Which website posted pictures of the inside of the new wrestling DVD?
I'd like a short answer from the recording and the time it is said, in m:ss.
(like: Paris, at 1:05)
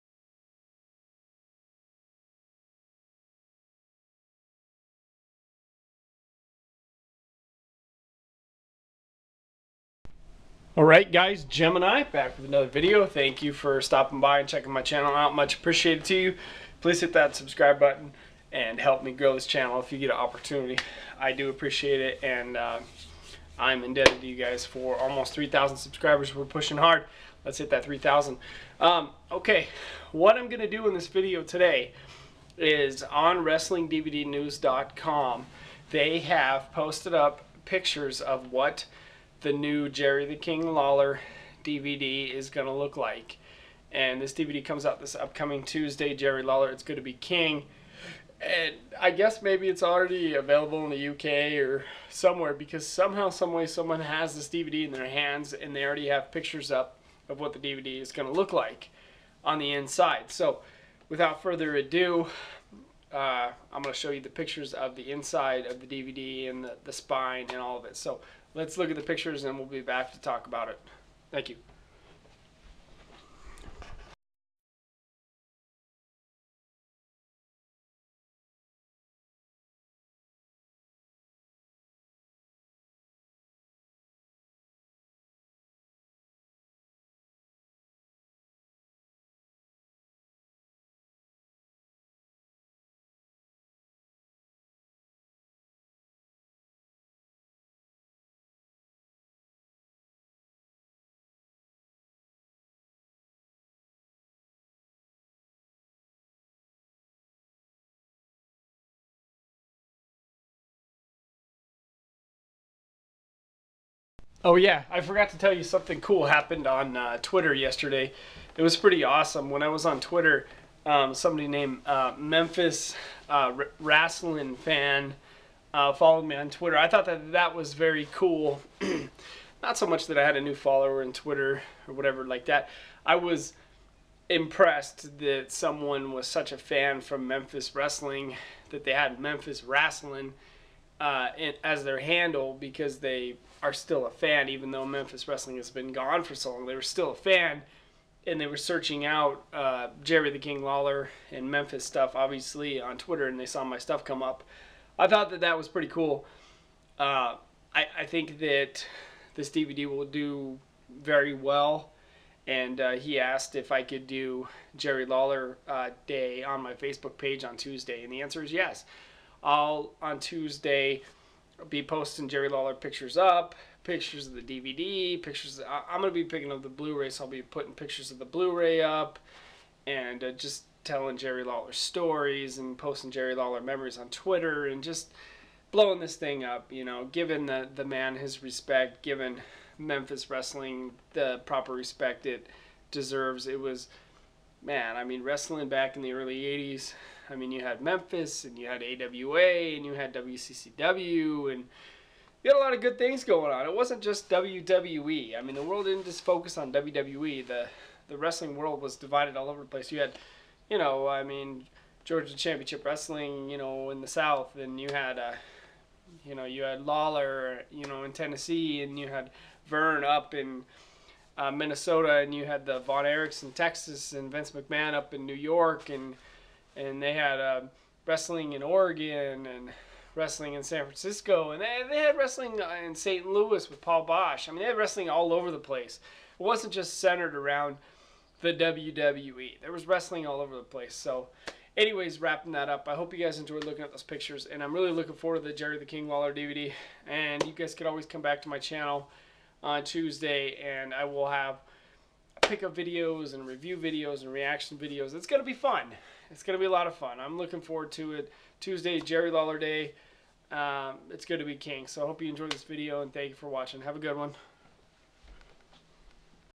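WrestlingDVDNews.com, at 0:33.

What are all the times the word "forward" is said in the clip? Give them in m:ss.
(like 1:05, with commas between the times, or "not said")
4:05, 4:17.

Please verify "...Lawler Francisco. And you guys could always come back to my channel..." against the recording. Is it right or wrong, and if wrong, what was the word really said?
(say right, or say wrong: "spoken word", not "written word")
wrong: "DVD", not "Francisco".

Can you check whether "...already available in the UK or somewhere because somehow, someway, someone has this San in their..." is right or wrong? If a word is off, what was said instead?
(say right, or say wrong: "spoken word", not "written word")
wrong: "DVD", not "San".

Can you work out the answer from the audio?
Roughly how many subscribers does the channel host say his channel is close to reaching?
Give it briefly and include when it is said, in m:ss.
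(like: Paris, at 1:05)
3,000, at 0:24.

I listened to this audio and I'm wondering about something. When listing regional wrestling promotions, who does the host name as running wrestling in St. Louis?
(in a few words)
Paul Boesch.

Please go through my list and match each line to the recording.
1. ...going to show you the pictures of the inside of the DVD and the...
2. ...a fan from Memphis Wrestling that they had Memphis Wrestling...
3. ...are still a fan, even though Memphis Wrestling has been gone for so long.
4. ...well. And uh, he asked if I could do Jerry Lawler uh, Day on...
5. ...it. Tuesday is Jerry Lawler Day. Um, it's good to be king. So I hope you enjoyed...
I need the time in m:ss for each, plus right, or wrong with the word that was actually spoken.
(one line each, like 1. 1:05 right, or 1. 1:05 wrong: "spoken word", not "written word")
1. 1:03 right
2. 2:16 right
3. 2:23 right
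4. 2:41 right
5. 4:18 right.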